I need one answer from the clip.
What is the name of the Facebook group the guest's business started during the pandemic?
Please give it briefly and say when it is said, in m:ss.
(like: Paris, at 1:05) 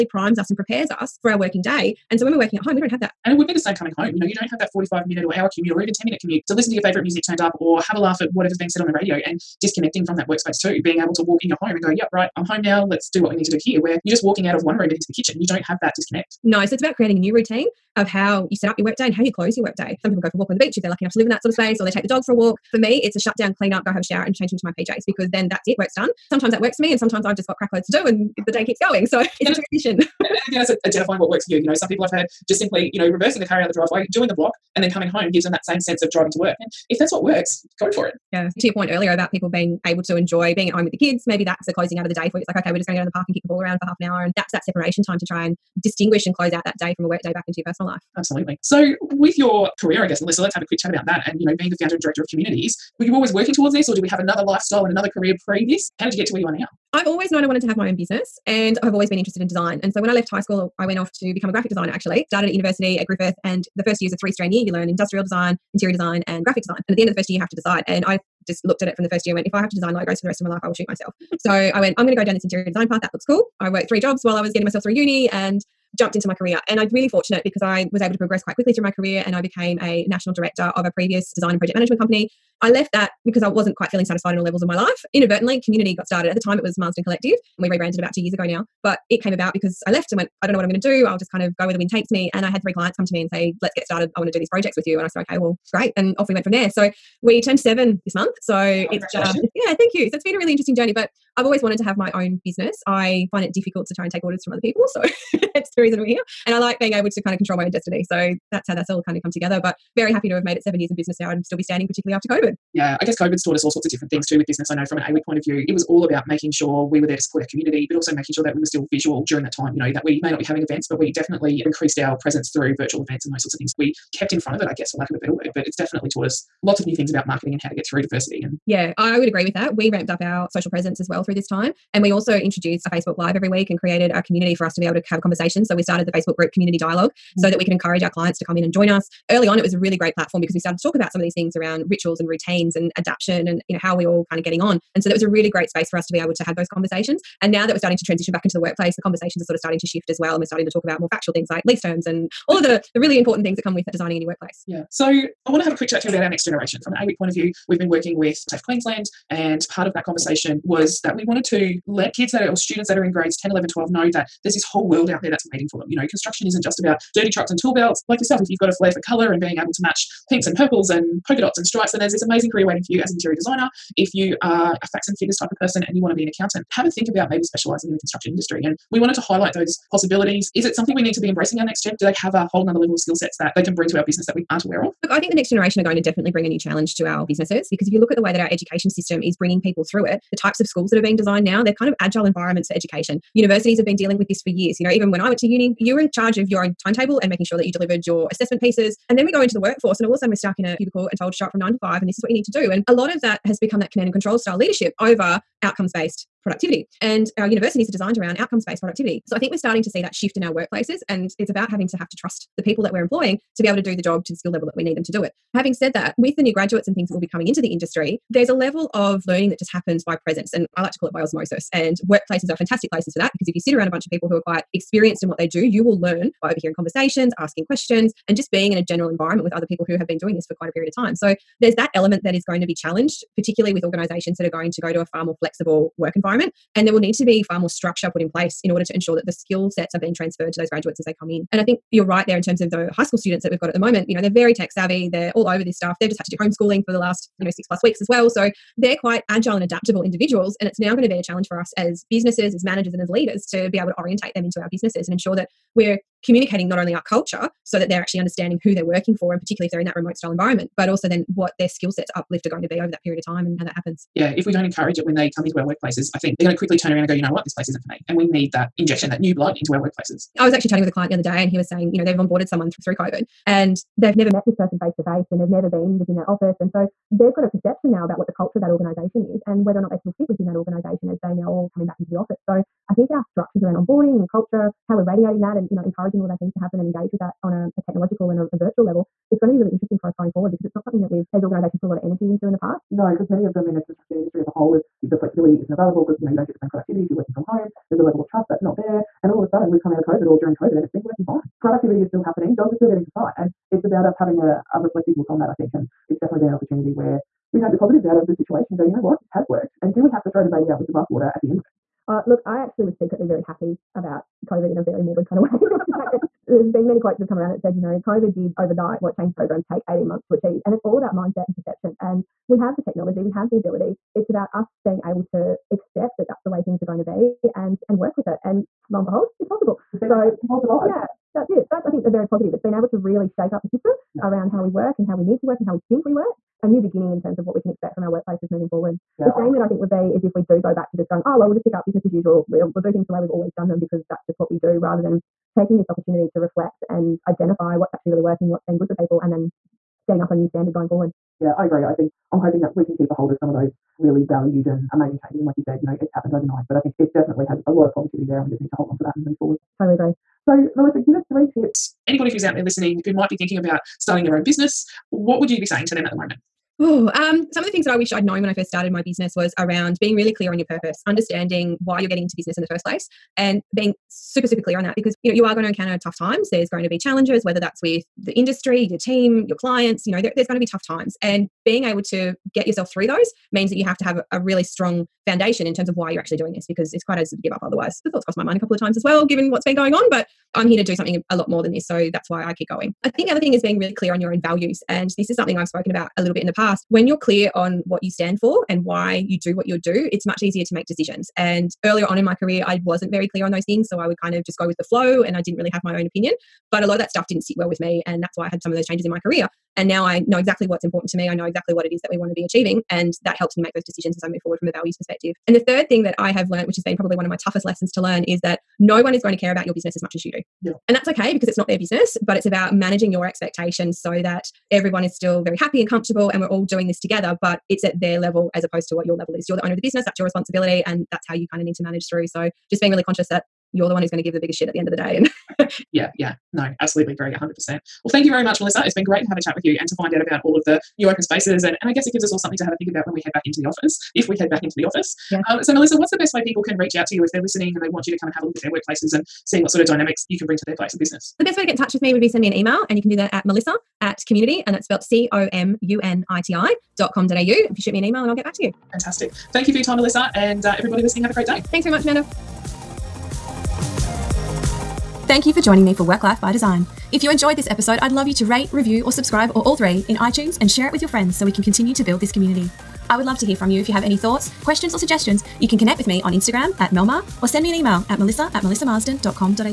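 COMUNiTI Dialogue, at 2:16.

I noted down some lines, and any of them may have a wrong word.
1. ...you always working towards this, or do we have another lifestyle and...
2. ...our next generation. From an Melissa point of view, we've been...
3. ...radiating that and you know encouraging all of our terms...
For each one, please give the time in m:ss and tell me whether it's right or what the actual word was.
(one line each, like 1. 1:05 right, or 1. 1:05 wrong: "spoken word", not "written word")
1. 0:53 right
2. 2:36 wrong: "AWIC", not "Melissa"
3. 4:45 wrong: "teams", not "terms".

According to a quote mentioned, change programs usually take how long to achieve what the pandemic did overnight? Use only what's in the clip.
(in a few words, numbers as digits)
18 months.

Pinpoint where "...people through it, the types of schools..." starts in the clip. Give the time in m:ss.
3:09.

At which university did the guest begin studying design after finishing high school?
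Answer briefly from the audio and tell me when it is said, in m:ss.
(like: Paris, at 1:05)
Griffith, at 1:03.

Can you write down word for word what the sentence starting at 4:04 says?
You know, they're very tech savvy, they're all over this stuff.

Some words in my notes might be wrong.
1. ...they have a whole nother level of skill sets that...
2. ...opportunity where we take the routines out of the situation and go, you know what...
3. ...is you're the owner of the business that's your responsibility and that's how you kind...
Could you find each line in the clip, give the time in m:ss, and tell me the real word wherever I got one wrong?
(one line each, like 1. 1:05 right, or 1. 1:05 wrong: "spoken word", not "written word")
1. 3:02 right
2. 5:06 wrong: "positives", not "routines"
3. 7:09 right.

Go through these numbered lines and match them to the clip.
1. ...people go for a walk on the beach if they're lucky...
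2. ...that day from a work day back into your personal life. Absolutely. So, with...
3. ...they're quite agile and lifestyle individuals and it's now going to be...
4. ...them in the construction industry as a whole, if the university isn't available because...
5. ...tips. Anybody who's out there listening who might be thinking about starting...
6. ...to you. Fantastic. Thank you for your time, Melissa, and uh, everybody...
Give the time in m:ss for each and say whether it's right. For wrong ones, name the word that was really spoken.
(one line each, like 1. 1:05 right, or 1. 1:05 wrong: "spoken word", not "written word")
1. 0:20 right
2. 0:46 right
3. 4:08 wrong: "adaptable", not "lifestyle"
4. 4:53 wrong: "flexibility", not "university"
5. 6:01 right
6. 7:38 right.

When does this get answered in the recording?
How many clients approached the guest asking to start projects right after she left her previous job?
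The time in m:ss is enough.
1:32.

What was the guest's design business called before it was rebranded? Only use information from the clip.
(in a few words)
Marsden Collective.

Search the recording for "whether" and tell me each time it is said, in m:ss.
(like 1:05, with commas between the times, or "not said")
4:39, 6:17.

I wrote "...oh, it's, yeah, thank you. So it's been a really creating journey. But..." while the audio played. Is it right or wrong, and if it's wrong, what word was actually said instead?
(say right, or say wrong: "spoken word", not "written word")
wrong: "interesting", not "creating".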